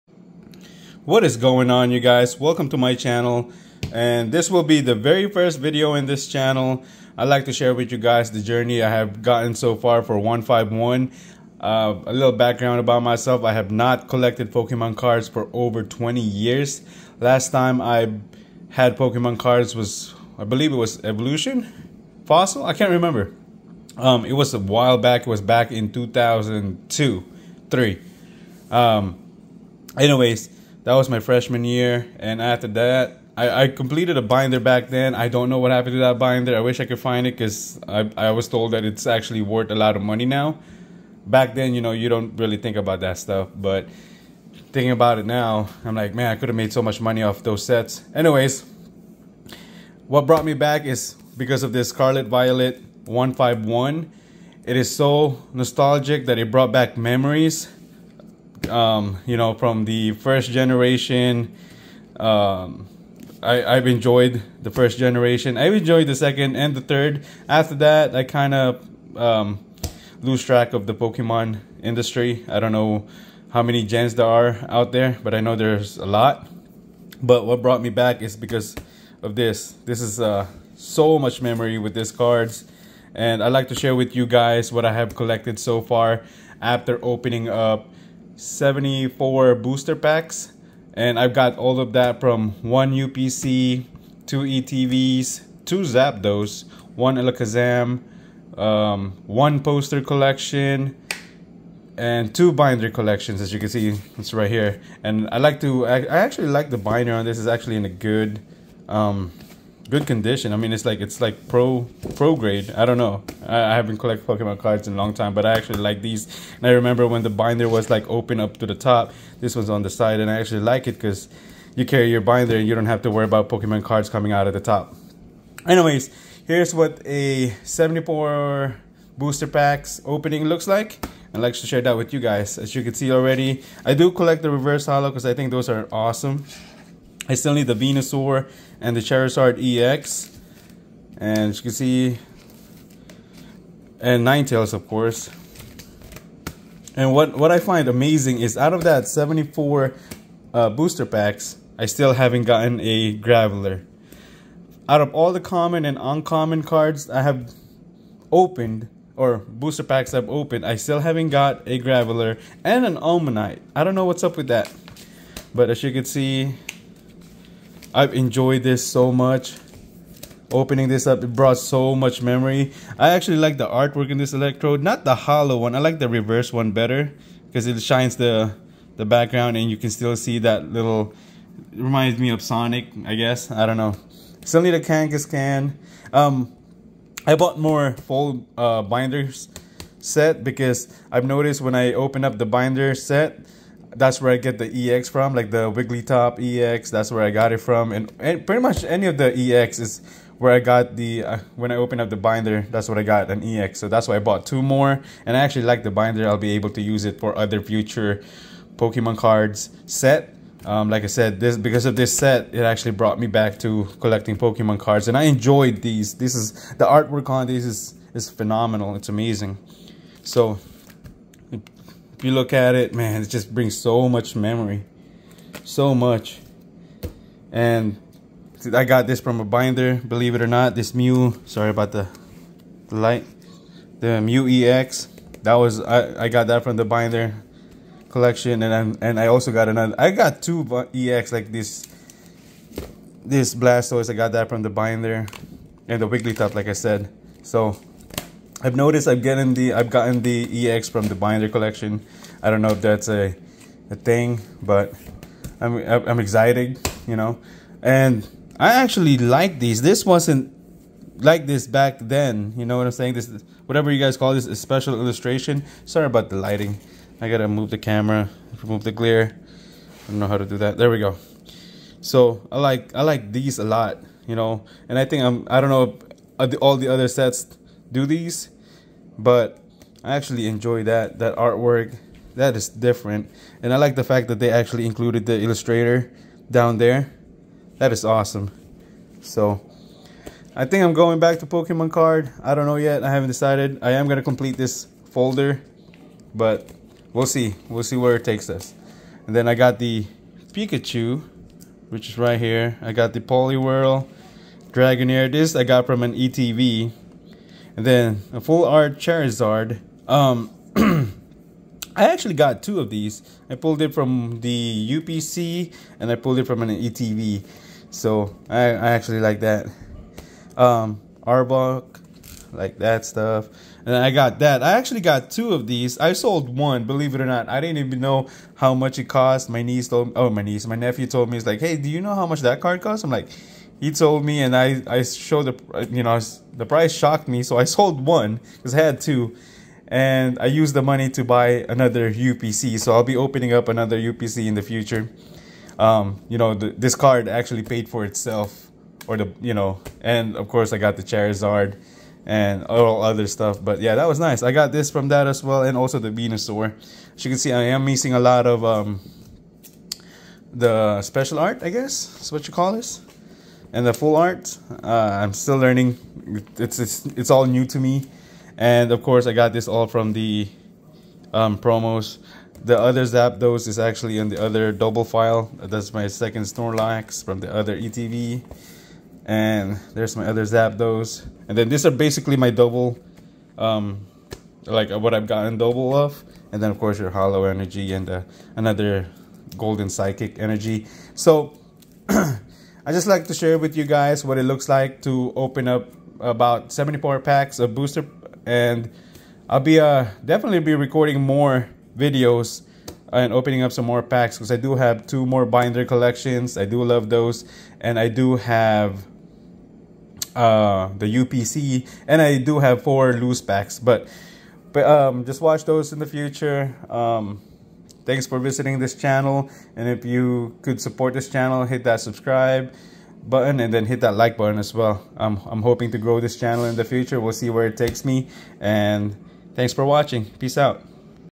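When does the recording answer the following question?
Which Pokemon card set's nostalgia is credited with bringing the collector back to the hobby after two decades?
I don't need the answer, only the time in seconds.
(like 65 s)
51 s.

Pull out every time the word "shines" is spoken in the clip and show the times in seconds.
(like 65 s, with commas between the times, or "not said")
177 s.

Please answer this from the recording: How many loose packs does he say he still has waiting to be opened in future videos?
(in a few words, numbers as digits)
4.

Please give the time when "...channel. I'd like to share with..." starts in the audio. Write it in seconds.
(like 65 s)
6 s.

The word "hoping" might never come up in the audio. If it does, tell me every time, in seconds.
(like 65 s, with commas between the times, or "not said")
425 s.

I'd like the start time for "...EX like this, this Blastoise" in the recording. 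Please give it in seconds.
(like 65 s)
240 s.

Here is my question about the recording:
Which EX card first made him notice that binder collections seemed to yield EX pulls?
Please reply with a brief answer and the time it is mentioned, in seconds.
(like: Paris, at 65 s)
Wigglytuff EX, at 195 s.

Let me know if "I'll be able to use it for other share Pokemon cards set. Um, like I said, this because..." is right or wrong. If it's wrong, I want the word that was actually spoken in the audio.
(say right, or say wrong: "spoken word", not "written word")
wrong: "future", not "share".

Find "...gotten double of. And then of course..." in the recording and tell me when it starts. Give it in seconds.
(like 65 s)
385 s.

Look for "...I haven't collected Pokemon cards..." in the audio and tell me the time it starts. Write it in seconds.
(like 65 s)
113 s.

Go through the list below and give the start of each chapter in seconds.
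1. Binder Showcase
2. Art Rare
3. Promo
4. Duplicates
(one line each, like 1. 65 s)
1. 132 s
2. 258 s
3. 360 s
4. 375 s.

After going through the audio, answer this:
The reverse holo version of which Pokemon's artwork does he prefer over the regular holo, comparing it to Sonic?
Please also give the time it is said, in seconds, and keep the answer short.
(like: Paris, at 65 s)
Electrode, at 174 s.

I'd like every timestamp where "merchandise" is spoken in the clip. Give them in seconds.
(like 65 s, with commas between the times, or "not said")
not said.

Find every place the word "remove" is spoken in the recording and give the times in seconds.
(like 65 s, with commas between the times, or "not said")
268 s.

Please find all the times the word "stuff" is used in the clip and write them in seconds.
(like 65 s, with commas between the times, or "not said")
43 s, 323 s, 353 s.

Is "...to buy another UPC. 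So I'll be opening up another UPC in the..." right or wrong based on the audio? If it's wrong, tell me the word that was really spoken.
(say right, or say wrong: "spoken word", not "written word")
right.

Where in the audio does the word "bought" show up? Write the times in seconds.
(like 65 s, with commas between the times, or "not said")
187 s, 204 s.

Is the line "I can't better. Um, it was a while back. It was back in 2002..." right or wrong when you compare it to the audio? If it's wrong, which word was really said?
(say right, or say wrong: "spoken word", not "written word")
wrong: "remember", not "better".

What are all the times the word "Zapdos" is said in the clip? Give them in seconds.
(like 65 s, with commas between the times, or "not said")
95 s, 373 s, 380 s.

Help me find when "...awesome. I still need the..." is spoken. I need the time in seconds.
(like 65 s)
135 s.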